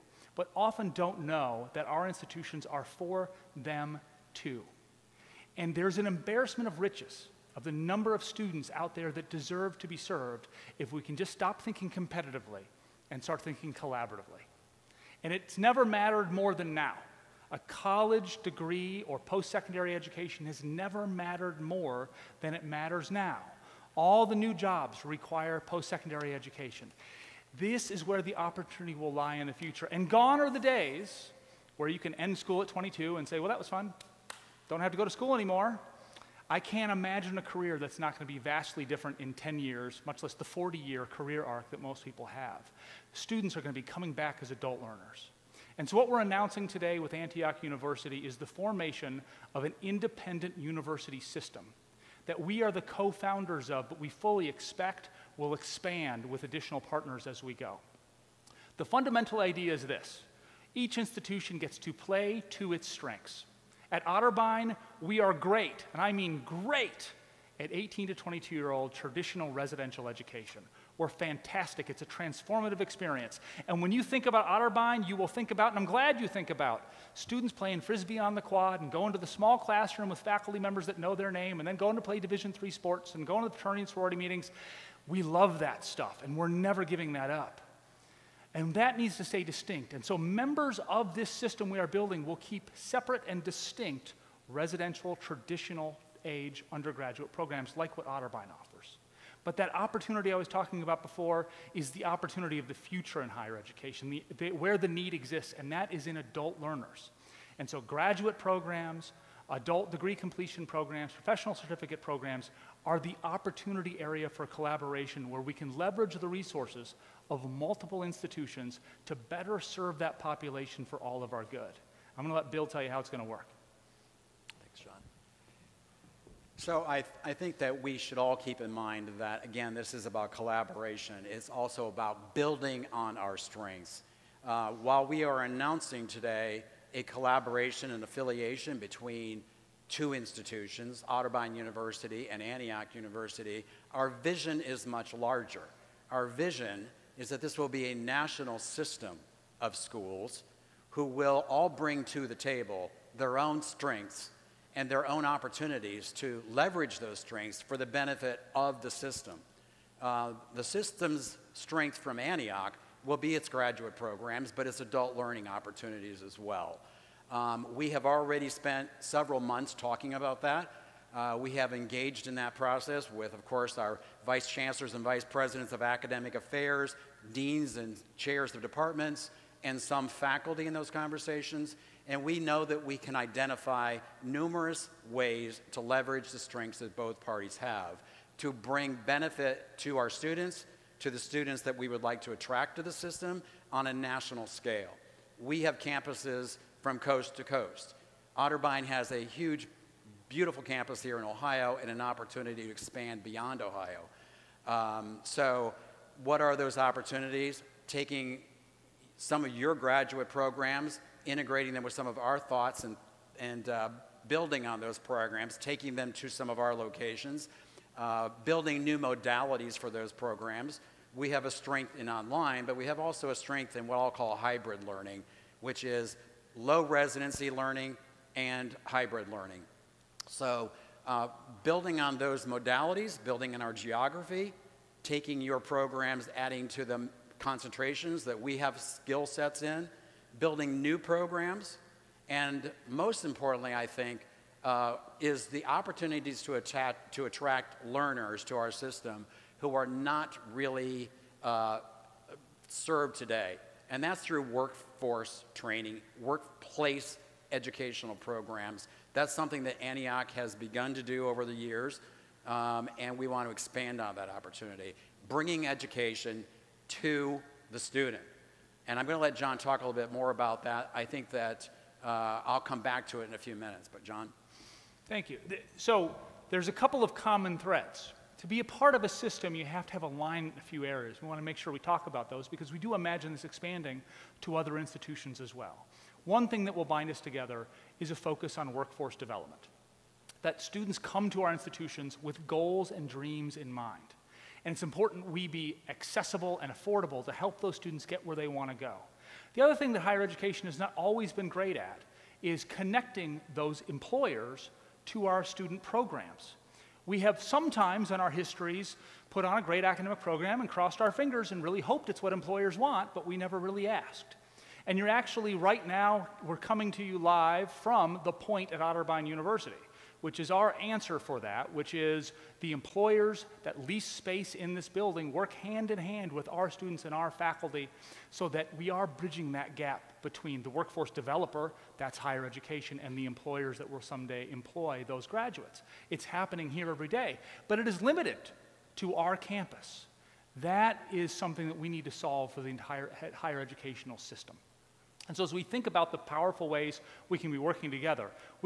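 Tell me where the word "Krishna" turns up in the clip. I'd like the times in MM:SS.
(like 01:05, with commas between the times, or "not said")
not said.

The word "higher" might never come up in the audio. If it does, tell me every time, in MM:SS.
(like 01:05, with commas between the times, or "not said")
01:43, 04:59, 05:32, 05:43.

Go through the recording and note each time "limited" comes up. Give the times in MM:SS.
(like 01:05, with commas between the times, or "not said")
05:38.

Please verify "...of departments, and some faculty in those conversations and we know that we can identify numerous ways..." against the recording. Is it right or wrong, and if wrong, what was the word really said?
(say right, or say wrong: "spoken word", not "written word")
right.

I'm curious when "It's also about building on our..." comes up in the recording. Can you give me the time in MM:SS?
02:11.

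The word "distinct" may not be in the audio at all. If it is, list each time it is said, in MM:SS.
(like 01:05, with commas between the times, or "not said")
01:29, 01:33.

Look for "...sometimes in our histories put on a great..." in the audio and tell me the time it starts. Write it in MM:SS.
05:07.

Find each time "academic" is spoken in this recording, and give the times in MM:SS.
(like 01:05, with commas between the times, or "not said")
02:55, 05:09.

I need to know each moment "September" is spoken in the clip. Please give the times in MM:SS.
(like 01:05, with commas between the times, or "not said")
not said.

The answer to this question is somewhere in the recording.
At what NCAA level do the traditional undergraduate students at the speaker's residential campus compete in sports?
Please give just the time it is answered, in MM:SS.
01:22.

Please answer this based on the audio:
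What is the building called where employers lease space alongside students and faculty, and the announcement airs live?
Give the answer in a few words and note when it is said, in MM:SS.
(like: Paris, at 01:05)
The Point, at 05:18.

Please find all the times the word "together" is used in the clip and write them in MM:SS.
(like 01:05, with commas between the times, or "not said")
04:47, 05:47.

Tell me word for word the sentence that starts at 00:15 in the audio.
And it's never mattered more than now.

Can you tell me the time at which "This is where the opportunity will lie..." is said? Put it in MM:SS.
00:27.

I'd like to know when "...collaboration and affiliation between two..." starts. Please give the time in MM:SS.
02:17.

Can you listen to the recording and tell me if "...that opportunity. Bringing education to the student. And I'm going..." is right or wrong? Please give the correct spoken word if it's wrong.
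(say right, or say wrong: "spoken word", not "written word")
right.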